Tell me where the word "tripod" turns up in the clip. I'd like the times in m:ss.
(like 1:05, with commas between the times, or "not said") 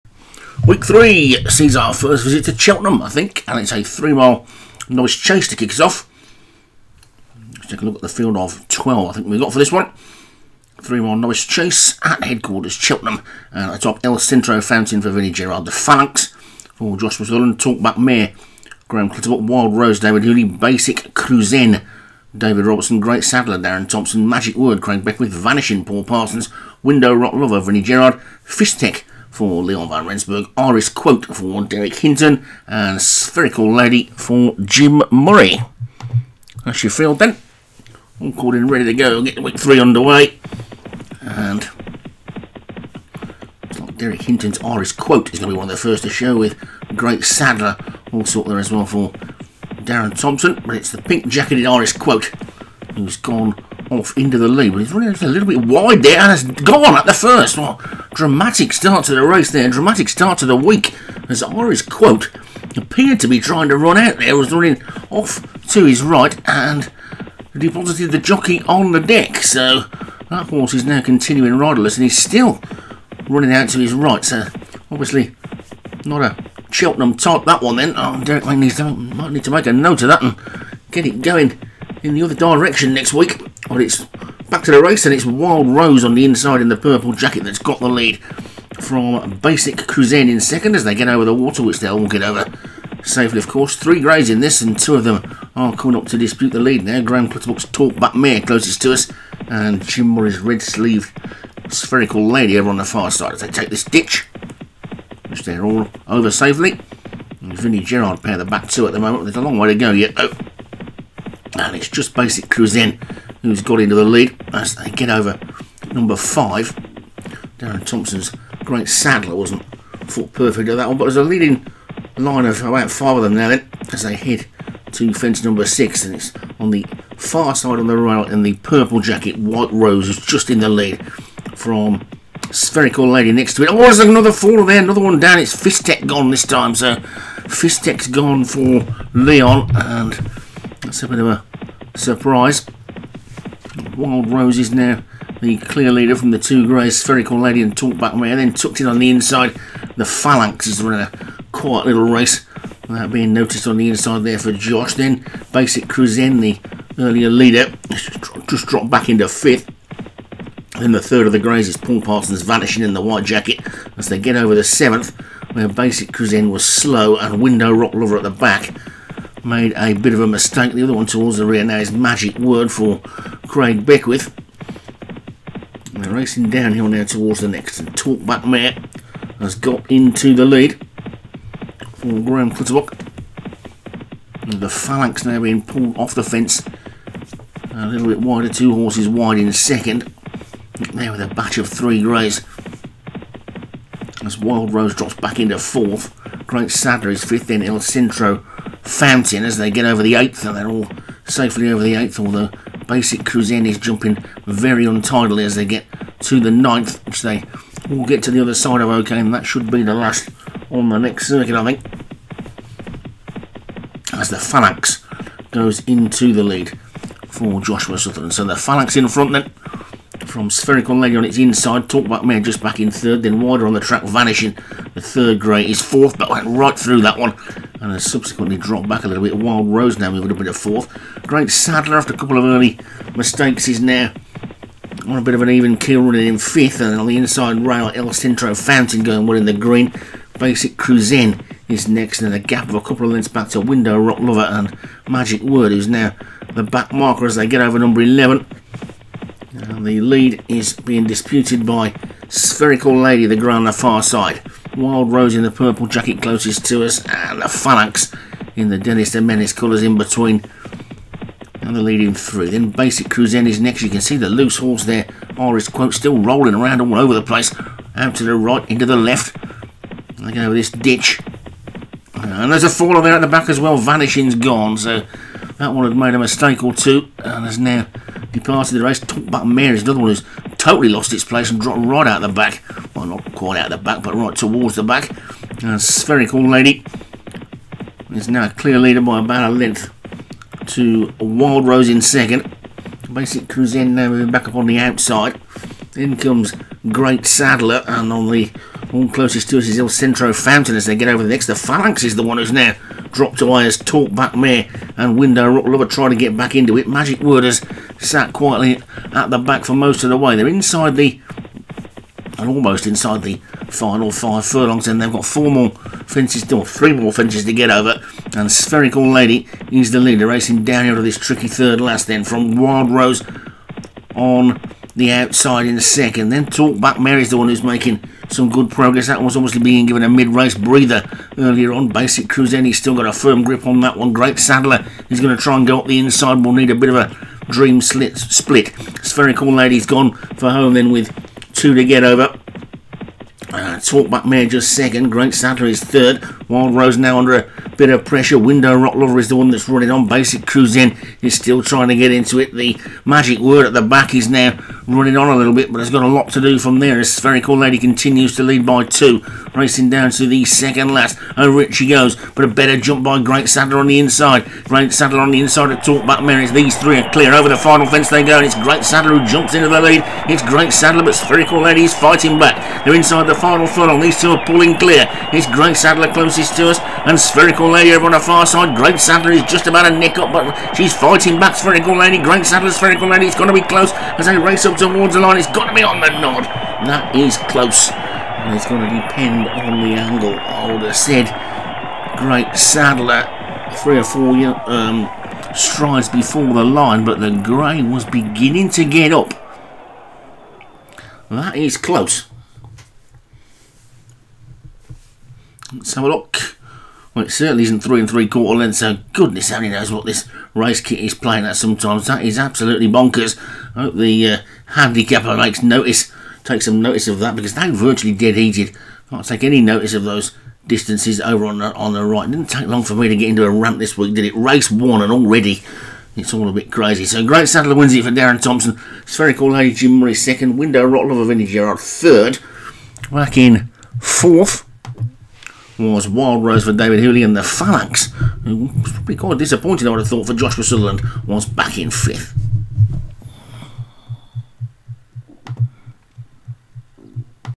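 not said.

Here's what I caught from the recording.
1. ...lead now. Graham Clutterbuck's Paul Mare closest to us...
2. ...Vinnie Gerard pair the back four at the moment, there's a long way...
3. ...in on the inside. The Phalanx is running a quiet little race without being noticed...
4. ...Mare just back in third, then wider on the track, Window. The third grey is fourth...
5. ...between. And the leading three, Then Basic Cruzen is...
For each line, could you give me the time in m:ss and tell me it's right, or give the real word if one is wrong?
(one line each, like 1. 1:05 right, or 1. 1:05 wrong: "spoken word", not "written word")
1. 1:36 wrong: "Talkback", not "Paul"
2. 1:47 wrong: "two", not "four"
3. 2:28 right
4. 3:42 wrong: "Vanishing", not "Window"
5. 4:19 right.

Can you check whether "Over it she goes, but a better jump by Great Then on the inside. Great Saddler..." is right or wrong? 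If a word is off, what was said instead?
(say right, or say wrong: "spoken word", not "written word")
wrong: "Saddler", not "Then".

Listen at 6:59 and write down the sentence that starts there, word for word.
Can't take any notice of those distances over on the, on the right.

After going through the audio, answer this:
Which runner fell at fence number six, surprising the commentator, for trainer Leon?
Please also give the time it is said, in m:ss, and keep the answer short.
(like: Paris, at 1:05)
Fistech, at 2:15.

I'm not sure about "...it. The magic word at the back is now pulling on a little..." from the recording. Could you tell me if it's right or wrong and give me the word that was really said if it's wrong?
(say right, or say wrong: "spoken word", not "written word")
wrong: "running", not "pulling".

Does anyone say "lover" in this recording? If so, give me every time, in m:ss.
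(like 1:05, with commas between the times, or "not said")
0:27, 2:47, 4:04, 5:05, 5:48, 7:11.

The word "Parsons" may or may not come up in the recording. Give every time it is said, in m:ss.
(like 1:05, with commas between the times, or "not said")
0:26, 2:42.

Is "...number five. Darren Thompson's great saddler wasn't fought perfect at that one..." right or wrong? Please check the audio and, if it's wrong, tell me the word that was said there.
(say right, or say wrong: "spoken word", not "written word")
right.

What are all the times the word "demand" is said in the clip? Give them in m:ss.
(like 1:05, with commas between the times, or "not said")
not said.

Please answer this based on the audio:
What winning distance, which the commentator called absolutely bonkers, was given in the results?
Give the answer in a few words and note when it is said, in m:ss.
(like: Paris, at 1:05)
3¾ lengths, at 6:47.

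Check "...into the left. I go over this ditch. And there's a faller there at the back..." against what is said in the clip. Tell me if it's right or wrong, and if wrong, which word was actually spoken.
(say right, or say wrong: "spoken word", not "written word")
right.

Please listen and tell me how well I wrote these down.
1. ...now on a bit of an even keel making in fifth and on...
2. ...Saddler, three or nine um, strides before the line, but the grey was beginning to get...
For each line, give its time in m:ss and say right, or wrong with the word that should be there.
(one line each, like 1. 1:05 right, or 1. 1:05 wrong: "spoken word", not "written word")
1. 3:53 wrong: "running", not "making"
2. 6:32 wrong: "four", not "nine".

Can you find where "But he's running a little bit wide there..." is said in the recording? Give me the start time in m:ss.
0:54.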